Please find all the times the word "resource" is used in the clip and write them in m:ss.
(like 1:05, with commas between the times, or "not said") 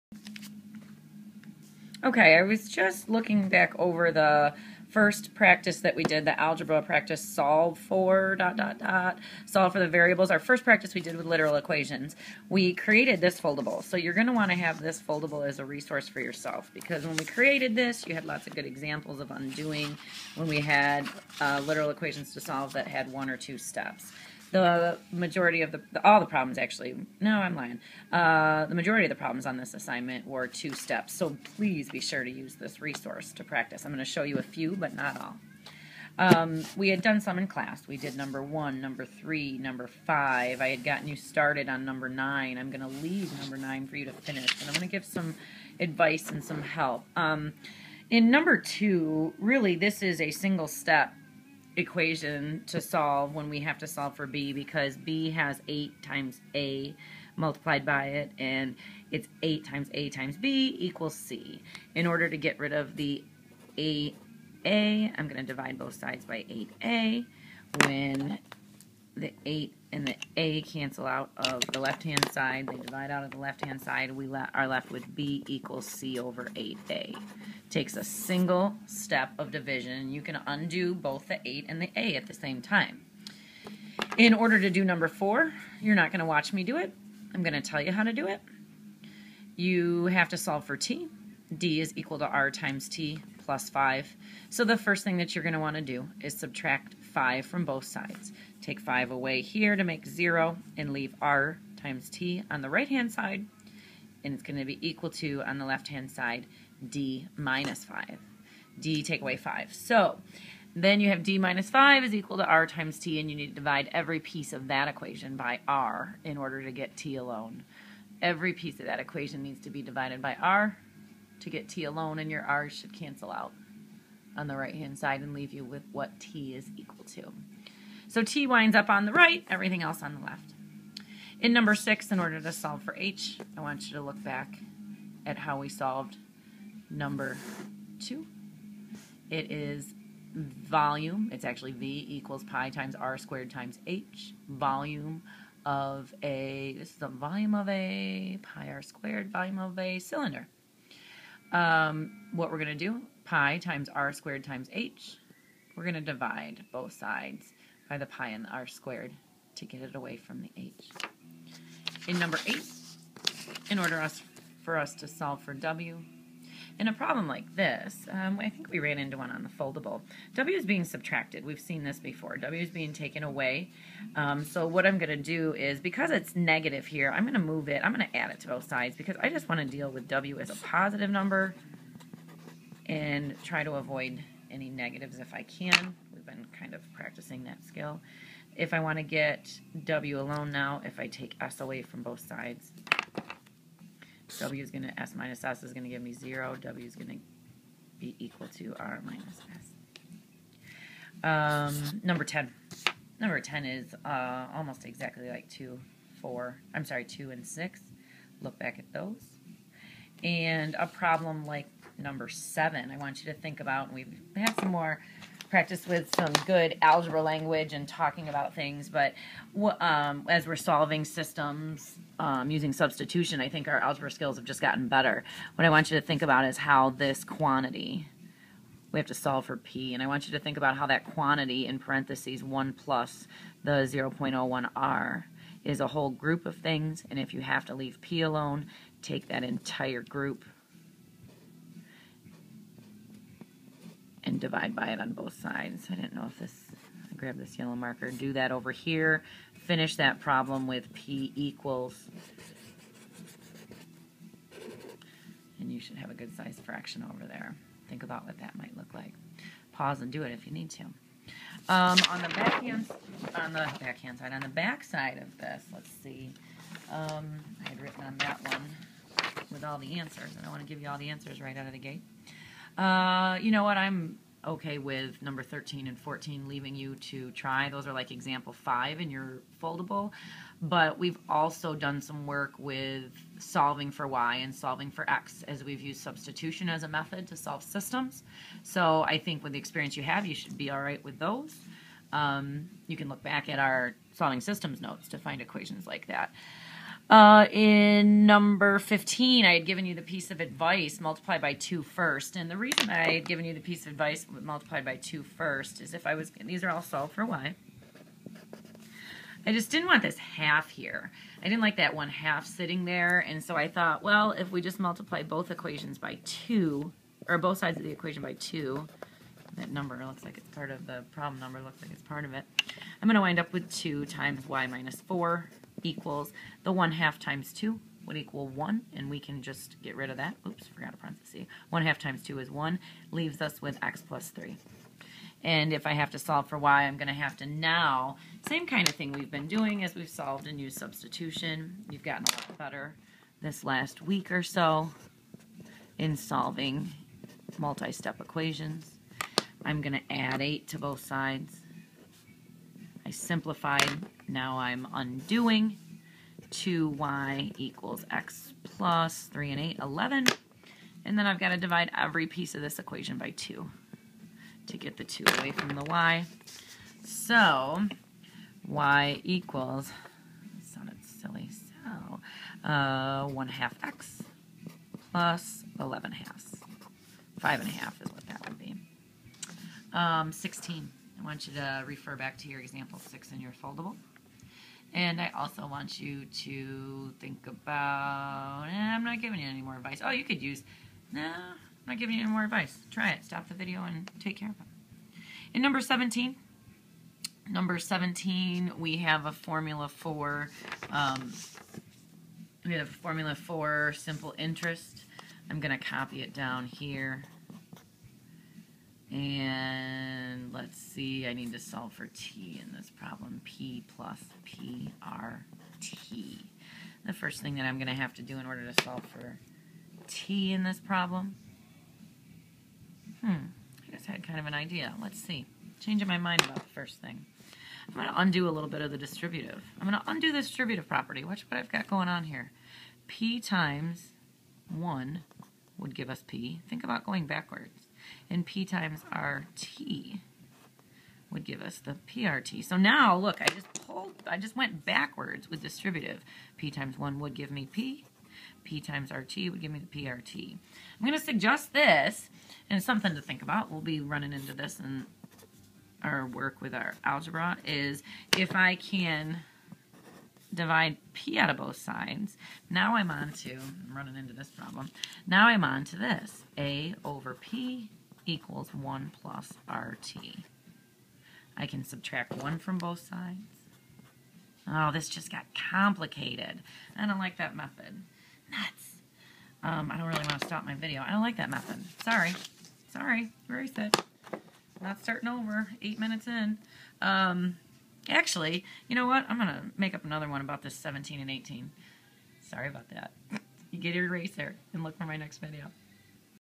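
0:15, 0:32.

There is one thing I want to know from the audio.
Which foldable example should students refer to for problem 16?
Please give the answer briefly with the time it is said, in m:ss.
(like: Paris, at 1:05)
example 6, at 6:22.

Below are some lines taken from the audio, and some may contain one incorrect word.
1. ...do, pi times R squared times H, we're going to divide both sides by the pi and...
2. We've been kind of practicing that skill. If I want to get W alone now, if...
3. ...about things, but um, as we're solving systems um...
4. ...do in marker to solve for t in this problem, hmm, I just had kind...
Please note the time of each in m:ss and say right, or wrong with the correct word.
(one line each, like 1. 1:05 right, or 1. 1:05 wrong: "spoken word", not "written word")
1. 2:32 right
2. 3:06 right
3. 3:38 right
4. 6:58 wrong: "order", not "marker".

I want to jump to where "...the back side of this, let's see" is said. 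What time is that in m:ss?
4:24.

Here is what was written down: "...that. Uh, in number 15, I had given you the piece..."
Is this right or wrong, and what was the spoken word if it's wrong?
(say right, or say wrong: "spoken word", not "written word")
right.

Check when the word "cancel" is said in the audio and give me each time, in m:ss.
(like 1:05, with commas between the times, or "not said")
1:10, 2:02.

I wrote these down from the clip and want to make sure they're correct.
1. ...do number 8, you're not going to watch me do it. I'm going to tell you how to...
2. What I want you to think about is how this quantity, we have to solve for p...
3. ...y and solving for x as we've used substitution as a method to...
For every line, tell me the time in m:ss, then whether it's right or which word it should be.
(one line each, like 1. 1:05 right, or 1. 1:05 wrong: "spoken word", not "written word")
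1. 1:24 wrong: "4", not "8"
2. 3:45 right
3. 4:44 right.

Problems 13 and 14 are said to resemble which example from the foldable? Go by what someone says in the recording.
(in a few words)
example 5.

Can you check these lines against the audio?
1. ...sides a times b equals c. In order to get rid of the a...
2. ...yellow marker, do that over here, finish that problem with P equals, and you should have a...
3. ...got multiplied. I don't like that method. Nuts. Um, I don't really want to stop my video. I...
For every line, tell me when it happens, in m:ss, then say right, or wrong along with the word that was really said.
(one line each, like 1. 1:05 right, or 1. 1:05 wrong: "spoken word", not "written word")
1. 0:59 wrong: "times", not "sides"
2. 4:07 right
3. 7:55 wrong: "complicated", not "multiplied".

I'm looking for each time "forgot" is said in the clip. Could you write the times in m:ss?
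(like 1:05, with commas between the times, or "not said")
5:30.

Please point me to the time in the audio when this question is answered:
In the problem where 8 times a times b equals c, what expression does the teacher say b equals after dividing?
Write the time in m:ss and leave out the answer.
1:15.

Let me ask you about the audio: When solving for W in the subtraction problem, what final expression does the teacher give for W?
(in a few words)
R minus S.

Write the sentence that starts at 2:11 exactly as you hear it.
In number 6, in order to solve for h, I want you to look back at how we solved number two.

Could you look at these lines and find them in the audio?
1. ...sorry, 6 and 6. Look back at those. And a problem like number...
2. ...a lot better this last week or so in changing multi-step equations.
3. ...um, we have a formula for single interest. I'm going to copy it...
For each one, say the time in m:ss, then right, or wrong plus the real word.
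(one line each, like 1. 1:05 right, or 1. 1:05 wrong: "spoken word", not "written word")
1. 3:26 wrong: "2", not "6"
2. 5:42 wrong: "solving", not "changing"
3. 6:40 wrong: "simple", not "single".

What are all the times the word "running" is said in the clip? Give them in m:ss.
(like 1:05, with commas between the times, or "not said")
7:34, 7:43.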